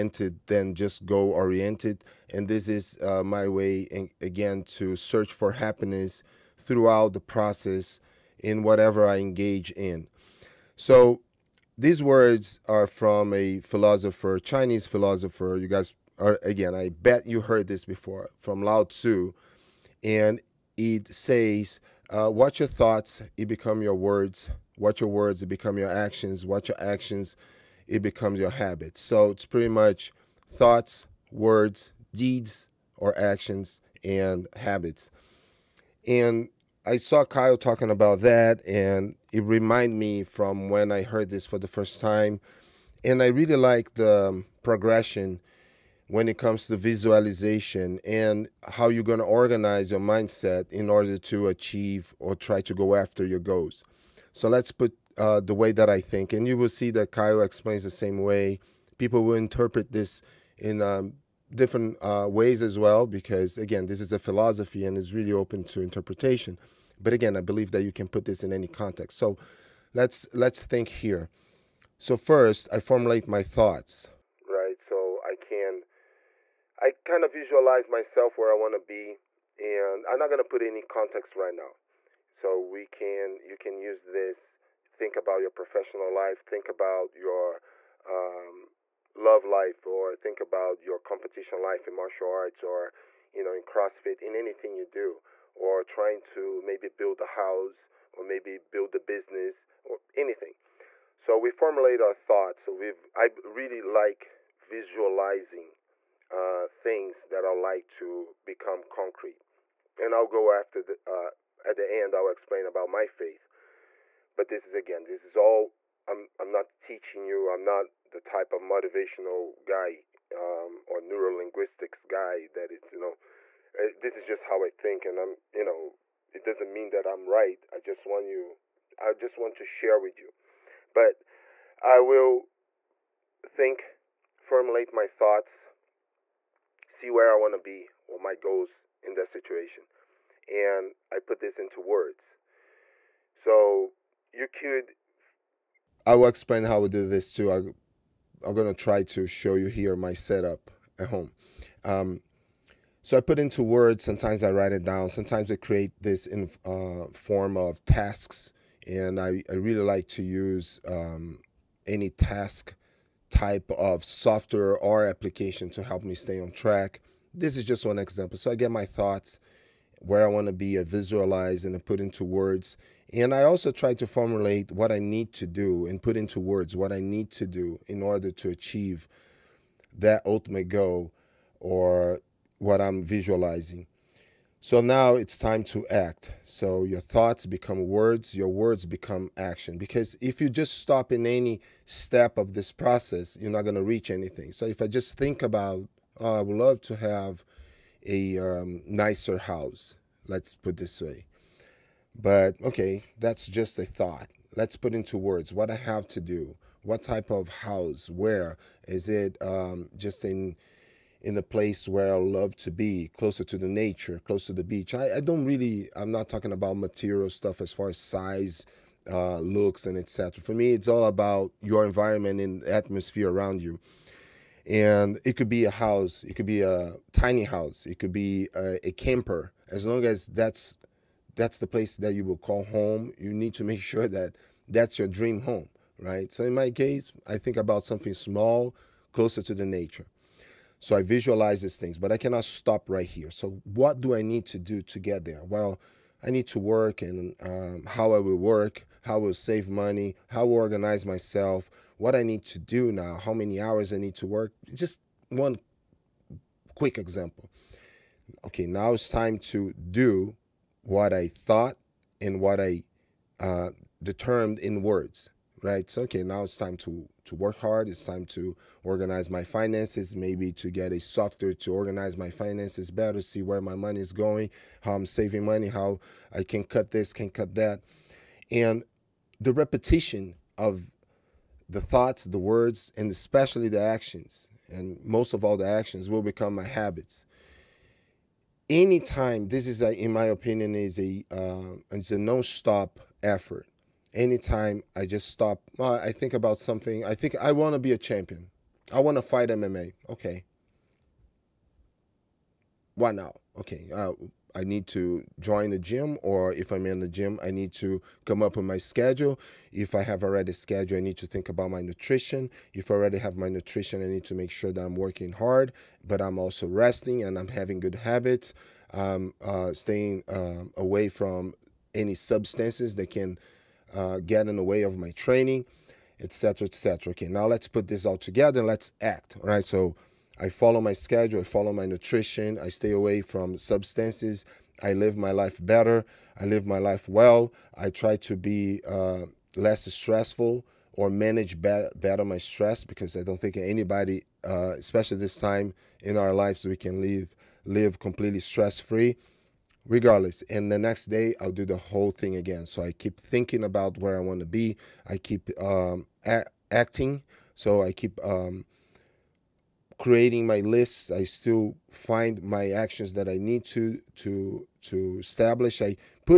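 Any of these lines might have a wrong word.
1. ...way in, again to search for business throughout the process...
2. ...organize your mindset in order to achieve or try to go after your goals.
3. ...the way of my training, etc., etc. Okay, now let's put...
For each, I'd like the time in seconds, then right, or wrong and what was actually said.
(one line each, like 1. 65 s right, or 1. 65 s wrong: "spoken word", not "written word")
1. 3 s wrong: "happiness", not "business"
2. 49 s right
3. 324 s right.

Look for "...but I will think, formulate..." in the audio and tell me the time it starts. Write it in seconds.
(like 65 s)
130 s.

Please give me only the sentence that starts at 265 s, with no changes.
So, okay, now it's time to to work hard.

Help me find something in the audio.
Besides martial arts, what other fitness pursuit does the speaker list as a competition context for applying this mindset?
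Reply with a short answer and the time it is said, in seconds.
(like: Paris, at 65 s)
CrossFit, at 93 s.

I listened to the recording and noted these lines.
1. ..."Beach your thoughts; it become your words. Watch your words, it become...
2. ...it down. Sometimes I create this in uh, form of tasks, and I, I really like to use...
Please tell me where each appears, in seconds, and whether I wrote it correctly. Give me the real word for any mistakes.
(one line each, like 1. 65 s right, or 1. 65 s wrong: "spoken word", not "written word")
1. 22 s wrong: "Watch", not "Beach"
2. 154 s right.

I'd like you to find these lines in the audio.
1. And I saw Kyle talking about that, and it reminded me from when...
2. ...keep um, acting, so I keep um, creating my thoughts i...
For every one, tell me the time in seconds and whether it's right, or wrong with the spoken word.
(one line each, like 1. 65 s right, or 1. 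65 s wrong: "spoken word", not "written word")
1. 36 s right
2. 355 s wrong: "lists", not "thoughts".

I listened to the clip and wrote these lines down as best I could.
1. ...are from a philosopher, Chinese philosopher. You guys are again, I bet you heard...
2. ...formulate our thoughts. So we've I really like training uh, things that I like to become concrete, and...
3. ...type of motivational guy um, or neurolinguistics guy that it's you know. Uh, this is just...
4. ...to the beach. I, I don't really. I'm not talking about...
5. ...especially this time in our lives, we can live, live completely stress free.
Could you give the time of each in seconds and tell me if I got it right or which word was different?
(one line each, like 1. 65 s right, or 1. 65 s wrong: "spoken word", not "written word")
1. 12 s right
2. 101 s wrong: "visualizing", not "training"
3. 118 s right
4. 214 s right
5. 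344 s right.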